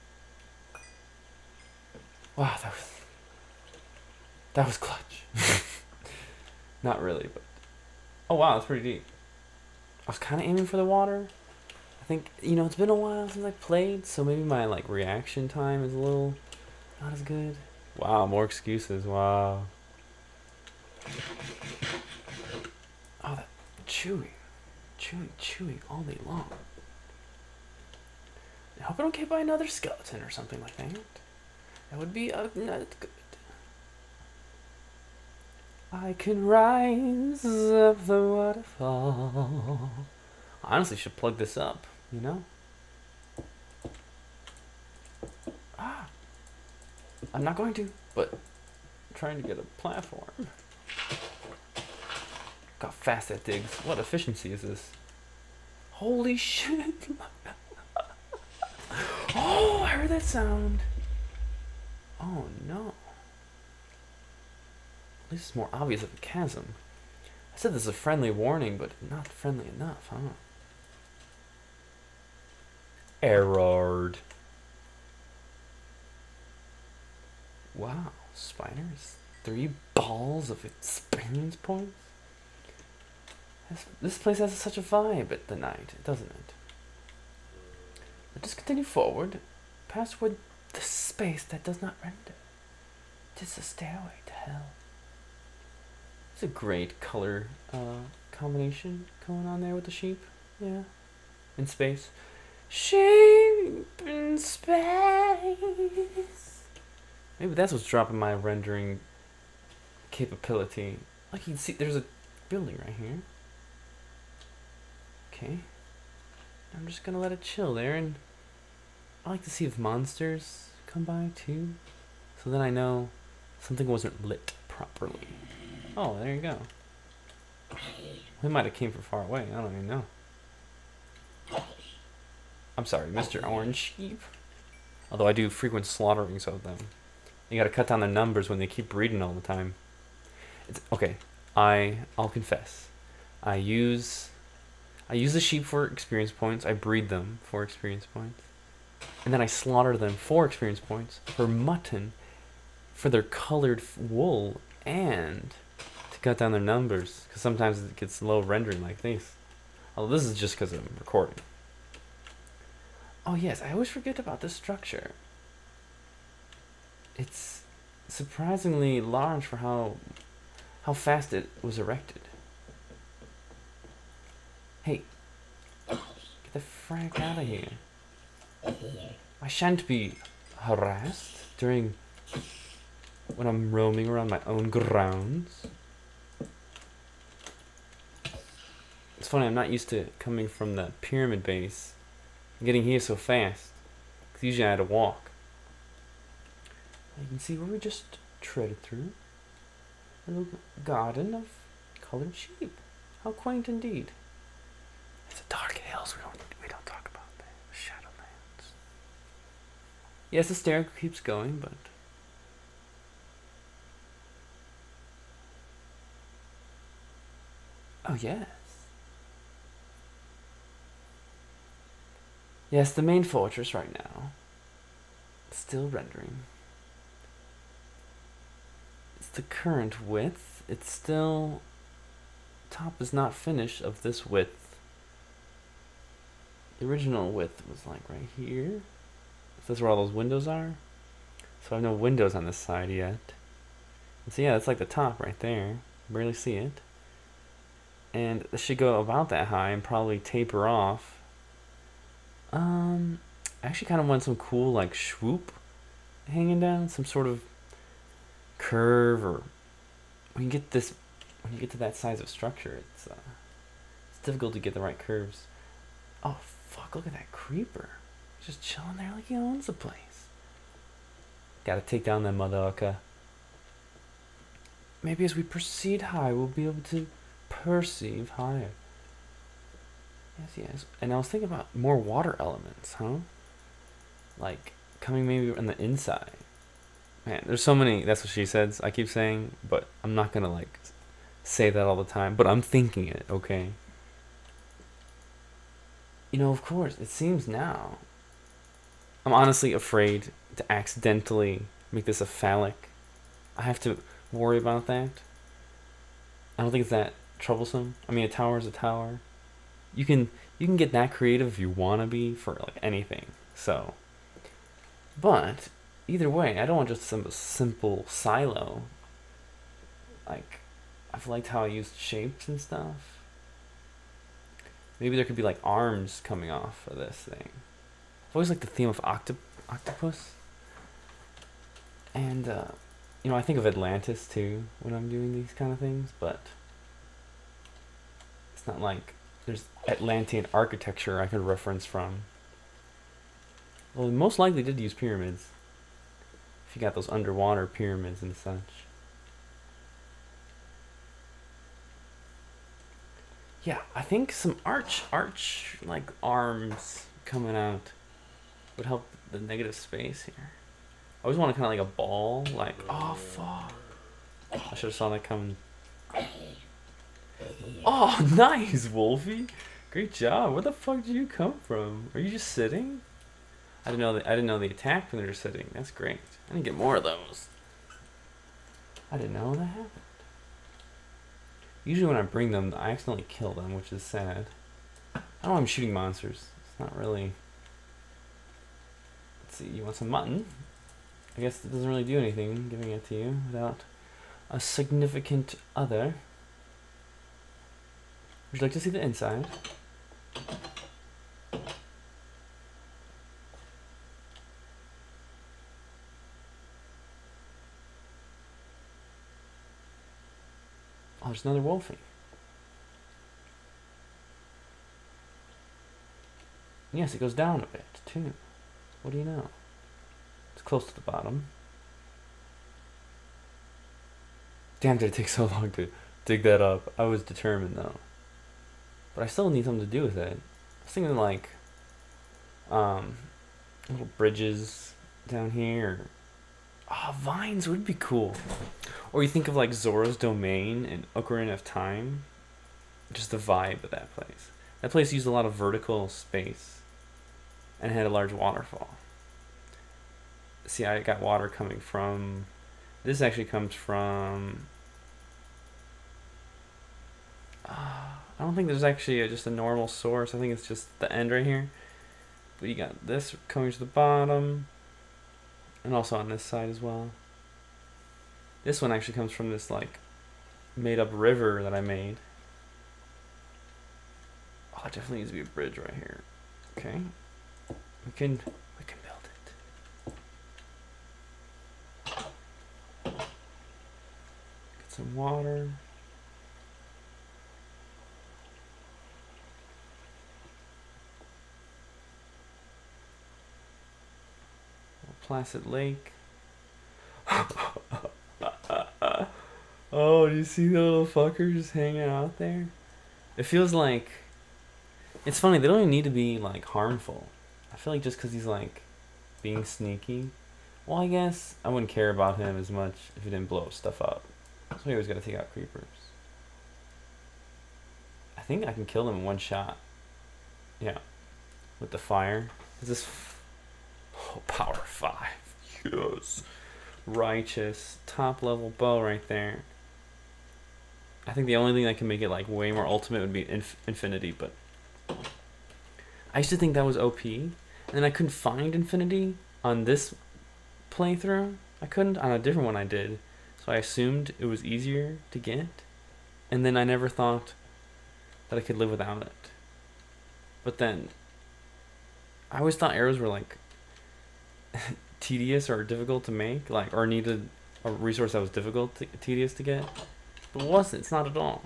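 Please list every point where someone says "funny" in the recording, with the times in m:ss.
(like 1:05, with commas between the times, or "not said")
3:09, 8:25.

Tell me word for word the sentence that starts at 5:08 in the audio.
I mean, a tower is a tower.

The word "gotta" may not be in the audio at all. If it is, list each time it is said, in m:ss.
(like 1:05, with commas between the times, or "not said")
2:17, 4:31.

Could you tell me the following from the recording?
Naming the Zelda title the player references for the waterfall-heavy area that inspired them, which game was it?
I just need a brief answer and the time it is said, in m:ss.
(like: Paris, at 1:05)
Ocarina of Time, at 7:21.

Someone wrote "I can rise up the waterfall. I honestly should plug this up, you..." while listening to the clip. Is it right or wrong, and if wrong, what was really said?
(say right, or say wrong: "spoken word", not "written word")
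right.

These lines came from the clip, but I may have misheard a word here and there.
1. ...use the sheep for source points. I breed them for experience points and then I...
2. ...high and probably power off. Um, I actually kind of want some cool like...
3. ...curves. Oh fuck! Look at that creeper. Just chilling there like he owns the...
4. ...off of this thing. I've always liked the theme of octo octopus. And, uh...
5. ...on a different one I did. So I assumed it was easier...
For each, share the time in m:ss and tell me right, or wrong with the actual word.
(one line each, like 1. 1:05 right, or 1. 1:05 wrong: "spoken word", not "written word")
1. 2:25 wrong: "experience", not "source"
2. 4:09 wrong: "taper", not "power"
3. 4:24 right
4. 5:26 right
5. 9:02 right.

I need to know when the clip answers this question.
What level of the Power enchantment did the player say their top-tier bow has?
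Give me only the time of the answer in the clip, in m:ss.
8:44.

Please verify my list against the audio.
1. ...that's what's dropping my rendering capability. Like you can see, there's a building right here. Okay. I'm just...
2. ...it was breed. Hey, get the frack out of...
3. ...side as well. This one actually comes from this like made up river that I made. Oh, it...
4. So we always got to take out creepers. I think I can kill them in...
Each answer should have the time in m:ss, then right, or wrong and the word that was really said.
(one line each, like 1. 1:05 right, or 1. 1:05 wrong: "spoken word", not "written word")
1. 1:47 right
2. 2:51 wrong: "erected", not "breed"
3. 7:46 right
4. 8:34 right.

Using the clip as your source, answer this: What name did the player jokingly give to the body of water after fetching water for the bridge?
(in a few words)
Placid Lake.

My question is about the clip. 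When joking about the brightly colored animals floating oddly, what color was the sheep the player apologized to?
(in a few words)
Orange.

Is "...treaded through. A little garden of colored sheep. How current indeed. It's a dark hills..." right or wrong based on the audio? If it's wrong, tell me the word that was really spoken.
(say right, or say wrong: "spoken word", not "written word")
wrong: "quaint", not "current".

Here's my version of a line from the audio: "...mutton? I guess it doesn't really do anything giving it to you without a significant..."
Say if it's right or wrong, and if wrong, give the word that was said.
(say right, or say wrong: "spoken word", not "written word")
right.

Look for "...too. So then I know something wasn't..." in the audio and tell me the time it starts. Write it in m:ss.
2:01.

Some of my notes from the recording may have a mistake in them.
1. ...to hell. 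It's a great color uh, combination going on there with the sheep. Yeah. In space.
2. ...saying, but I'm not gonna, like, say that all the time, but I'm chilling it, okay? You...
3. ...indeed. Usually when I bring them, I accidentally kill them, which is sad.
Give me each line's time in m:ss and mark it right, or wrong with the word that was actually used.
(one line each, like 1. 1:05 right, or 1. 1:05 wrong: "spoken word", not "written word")
1. 1:34 right
2. 4:49 wrong: "thinking", not "chilling"
3. 6:19 wrong: "happened", not "indeed".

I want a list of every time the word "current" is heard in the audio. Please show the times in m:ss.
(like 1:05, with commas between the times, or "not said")
3:49.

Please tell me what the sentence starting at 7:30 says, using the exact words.
See, I got water coming from.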